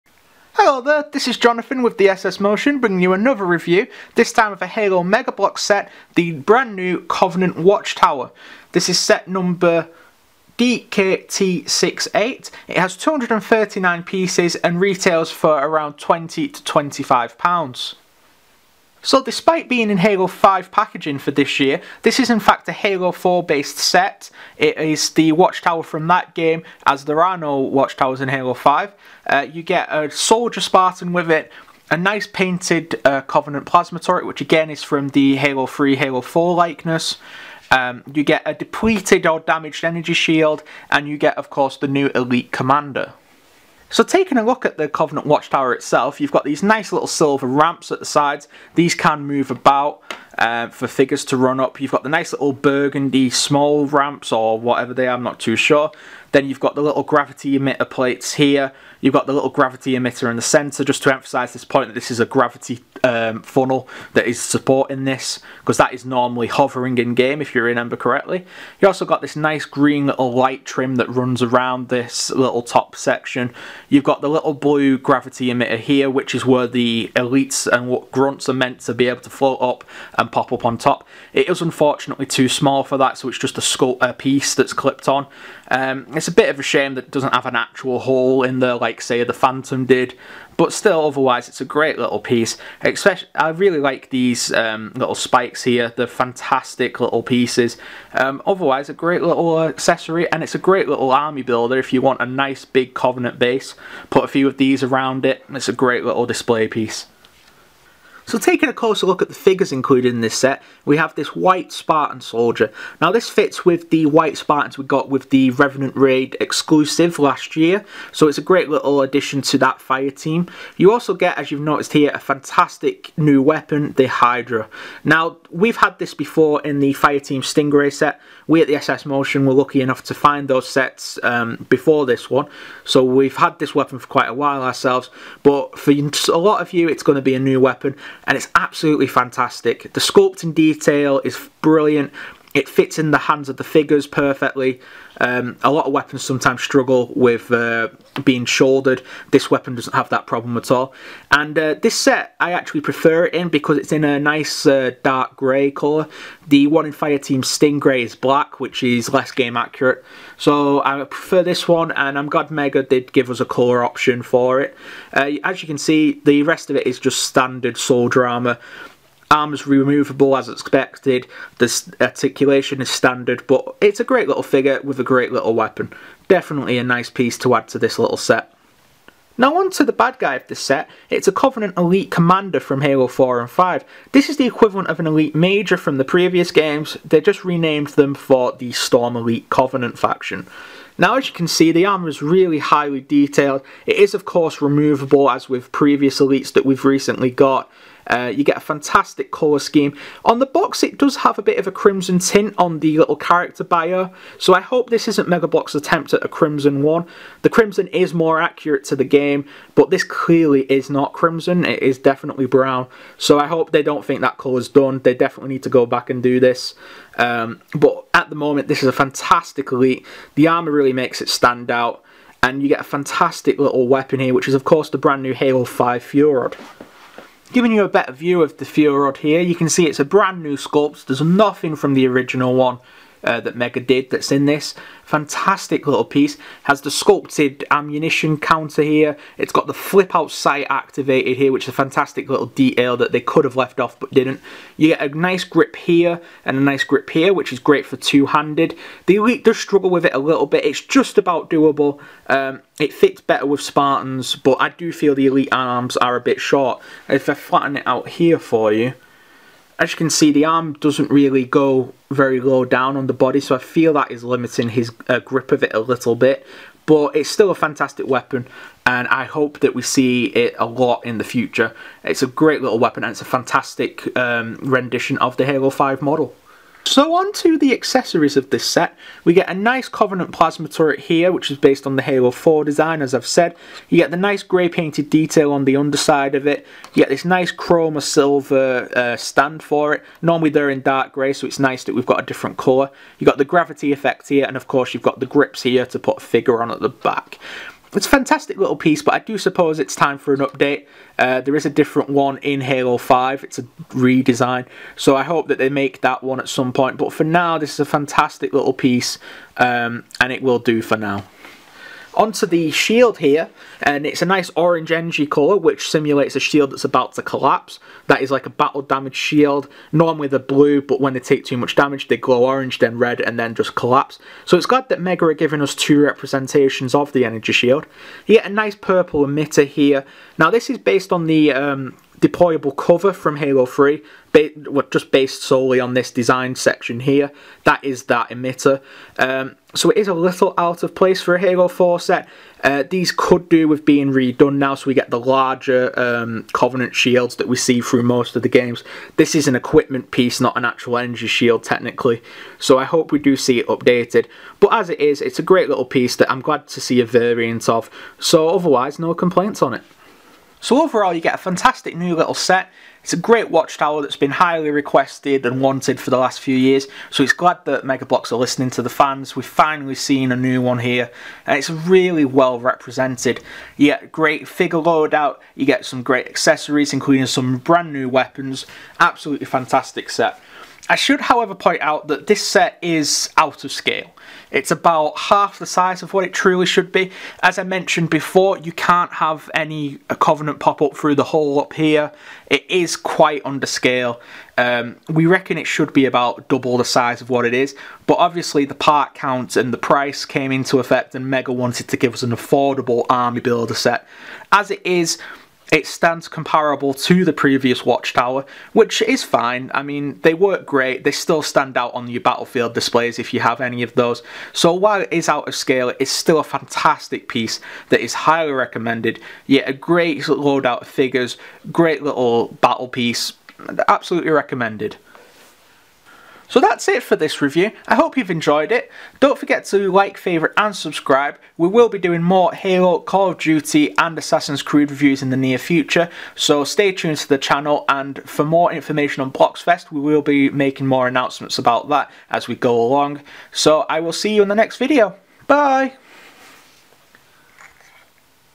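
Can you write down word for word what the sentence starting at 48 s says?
These can move about uh, for figures to run up.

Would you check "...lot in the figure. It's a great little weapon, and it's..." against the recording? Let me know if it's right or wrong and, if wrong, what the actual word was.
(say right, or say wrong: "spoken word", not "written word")
wrong: "future", not "figure".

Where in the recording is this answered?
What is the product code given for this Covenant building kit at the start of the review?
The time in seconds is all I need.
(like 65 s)
10 s.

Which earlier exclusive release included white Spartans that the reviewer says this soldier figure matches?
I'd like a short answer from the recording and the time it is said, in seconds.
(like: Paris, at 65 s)
Revenant Raid, at 115 s.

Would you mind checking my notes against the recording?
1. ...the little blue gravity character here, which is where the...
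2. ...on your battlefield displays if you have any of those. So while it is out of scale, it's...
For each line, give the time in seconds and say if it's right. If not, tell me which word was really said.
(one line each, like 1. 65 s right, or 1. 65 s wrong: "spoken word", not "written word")
1. 74 s wrong: "emitter", not "character"
2. 411 s right.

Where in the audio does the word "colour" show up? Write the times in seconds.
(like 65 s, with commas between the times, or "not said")
155 s, 163 s, 199 s, 214 s, 292 s, 315 s.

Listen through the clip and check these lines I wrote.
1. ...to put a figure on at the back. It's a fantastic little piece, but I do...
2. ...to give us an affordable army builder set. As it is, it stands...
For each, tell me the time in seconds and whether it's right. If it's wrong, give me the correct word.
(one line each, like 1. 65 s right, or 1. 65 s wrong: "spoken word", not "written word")
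1. 295 s right
2. 401 s right.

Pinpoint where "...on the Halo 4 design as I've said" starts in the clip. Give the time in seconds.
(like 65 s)
281 s.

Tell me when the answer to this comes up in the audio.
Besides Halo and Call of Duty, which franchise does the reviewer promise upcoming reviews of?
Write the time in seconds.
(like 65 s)
434 s.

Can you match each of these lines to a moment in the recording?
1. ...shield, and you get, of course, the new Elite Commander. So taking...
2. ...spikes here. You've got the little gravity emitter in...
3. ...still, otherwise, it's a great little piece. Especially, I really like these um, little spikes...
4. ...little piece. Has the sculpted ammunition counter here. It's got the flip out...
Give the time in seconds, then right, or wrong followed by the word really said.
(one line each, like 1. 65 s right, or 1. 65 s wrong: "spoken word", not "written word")
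1. 40 s right
2. 57 s wrong: "plates", not "spikes"
3. 90 s right
4. 235 s right.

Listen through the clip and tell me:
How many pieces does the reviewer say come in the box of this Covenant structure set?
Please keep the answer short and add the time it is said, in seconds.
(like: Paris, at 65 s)
239, at 12 s.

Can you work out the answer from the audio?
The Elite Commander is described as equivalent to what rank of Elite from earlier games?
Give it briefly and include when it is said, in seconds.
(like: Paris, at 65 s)
Elite Major, at 185 s.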